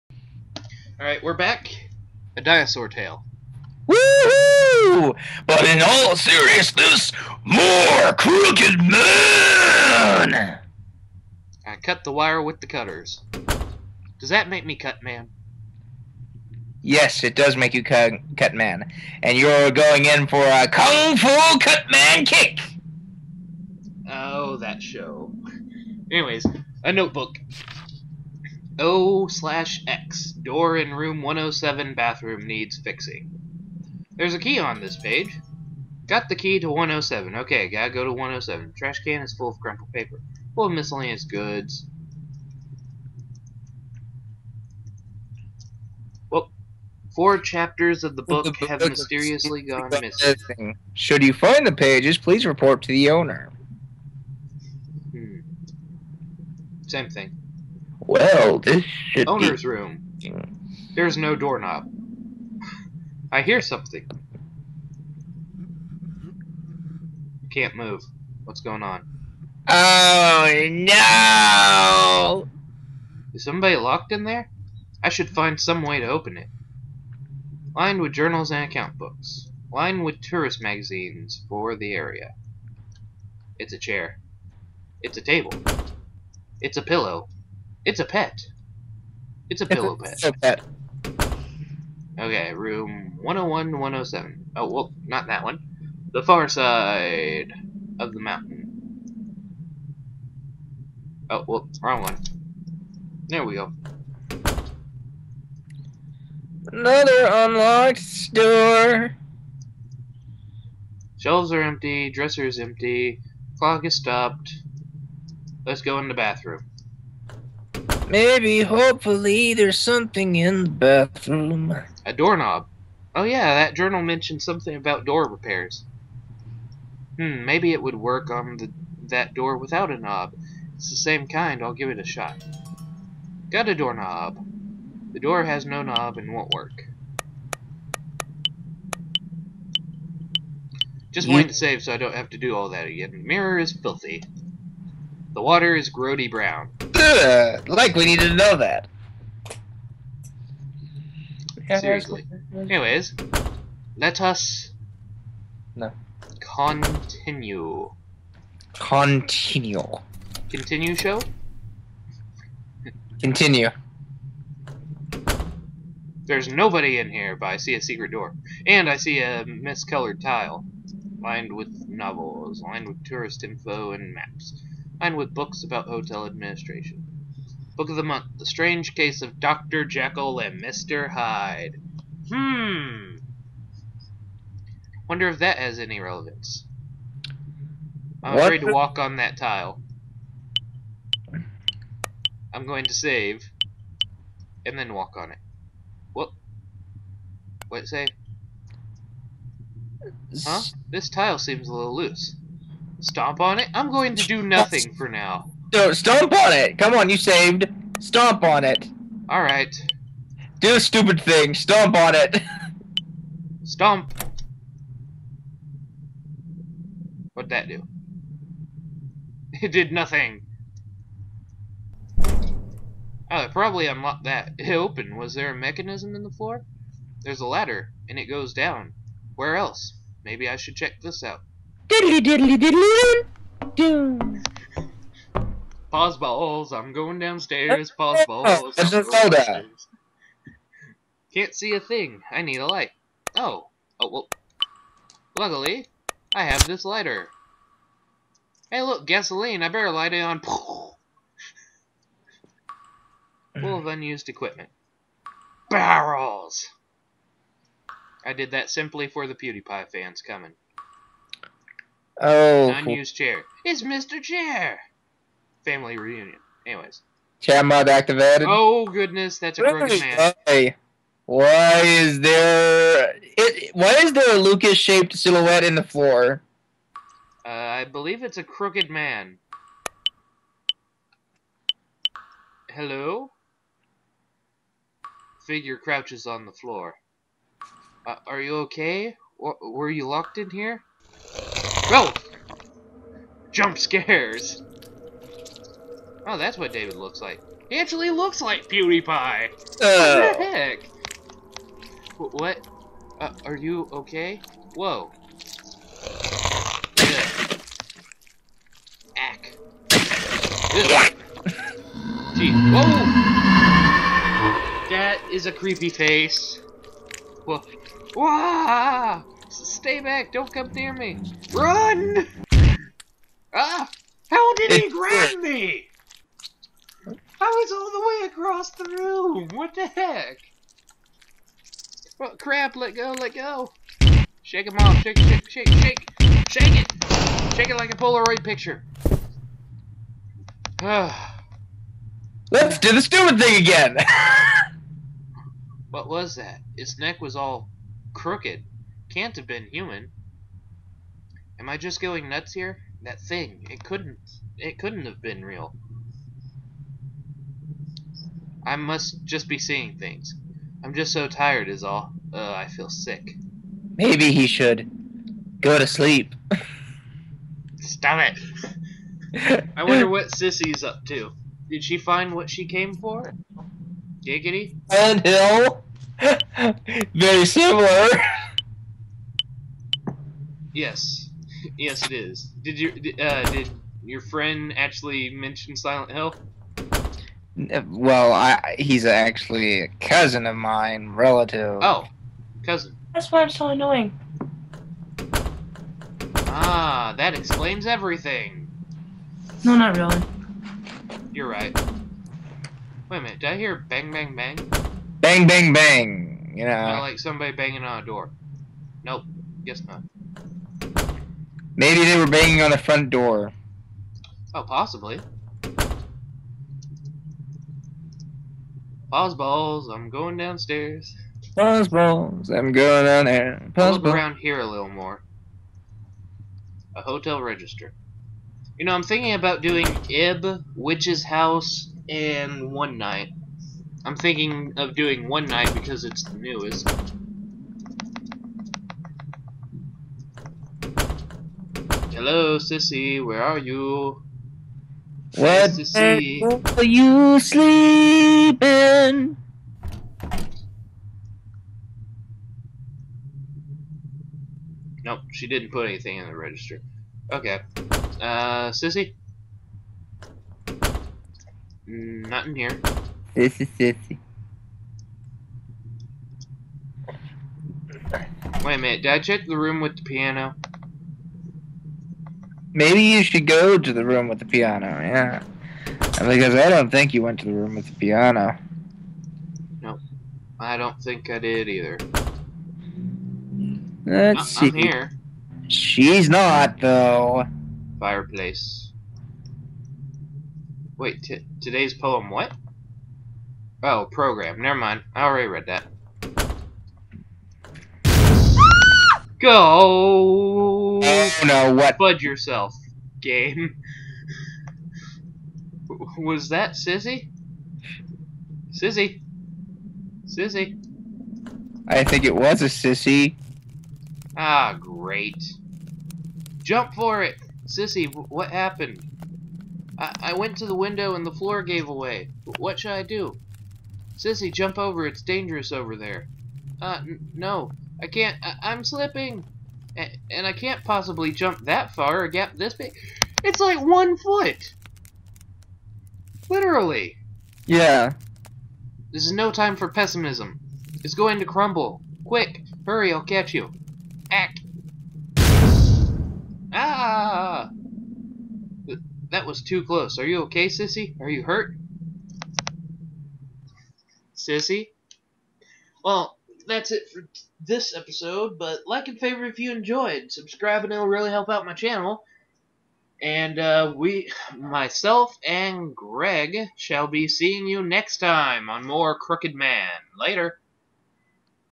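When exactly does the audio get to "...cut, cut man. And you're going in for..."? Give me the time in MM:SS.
00:17.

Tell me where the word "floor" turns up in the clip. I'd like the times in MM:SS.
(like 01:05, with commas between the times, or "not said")
03:46, 04:35, 04:46, 08:41.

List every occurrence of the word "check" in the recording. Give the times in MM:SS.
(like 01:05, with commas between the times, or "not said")
03:50, 07:49.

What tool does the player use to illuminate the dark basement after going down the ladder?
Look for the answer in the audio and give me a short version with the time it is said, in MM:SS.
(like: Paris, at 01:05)
Lighter, at 04:06.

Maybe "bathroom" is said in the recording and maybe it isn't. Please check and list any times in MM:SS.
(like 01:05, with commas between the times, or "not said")
00:31, 01:56, 02:00.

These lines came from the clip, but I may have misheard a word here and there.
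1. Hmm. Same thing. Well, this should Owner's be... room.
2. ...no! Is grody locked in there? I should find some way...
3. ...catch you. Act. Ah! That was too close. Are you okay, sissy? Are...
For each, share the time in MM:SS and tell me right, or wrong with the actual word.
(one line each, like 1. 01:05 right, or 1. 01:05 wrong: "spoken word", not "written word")
1. 00:55 right
2. 01:10 wrong: "somebody", not "grody"
3. 09:03 right.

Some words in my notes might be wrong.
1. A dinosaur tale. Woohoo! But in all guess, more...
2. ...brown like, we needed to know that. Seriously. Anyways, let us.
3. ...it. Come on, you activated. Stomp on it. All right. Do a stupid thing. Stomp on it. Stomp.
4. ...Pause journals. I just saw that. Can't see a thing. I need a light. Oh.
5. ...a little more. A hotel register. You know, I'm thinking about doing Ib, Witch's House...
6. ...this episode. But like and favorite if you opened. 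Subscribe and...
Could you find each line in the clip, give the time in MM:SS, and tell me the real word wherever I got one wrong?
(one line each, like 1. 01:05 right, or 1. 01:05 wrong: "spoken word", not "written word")
1. 00:02 wrong: "seriousness", not "guess"
2. 02:26 right
3. 03:26 wrong: "saved", not "activated"
4. 03:57 wrong: "balls", not "journals"
5. 07:04 right
6. 09:17 wrong: "enjoyed", not "opened".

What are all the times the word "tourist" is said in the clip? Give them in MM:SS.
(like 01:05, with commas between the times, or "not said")
01:20, 02:53.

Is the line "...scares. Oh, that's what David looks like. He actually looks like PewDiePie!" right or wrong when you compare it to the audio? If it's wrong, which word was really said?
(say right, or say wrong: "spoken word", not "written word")
right.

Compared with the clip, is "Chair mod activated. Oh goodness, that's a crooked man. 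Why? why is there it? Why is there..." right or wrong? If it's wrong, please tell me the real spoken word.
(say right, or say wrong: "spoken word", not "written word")
right.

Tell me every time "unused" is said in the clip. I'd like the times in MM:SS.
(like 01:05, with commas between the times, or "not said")
04:13, 04:22.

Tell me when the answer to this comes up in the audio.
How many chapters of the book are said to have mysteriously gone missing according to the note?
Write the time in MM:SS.
00:47.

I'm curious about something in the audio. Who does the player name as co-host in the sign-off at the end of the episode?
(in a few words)
Greg.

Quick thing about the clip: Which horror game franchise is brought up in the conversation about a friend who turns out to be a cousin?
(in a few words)
Silent Hill.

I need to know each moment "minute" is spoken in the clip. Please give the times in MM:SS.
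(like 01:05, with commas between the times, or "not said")
06:43, 07:48.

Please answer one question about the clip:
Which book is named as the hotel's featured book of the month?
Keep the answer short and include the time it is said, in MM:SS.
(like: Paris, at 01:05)
The Strange Case of Dr. Jekyll and Mr. Hyde, at 02:58.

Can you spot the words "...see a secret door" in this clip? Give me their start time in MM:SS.
02:47.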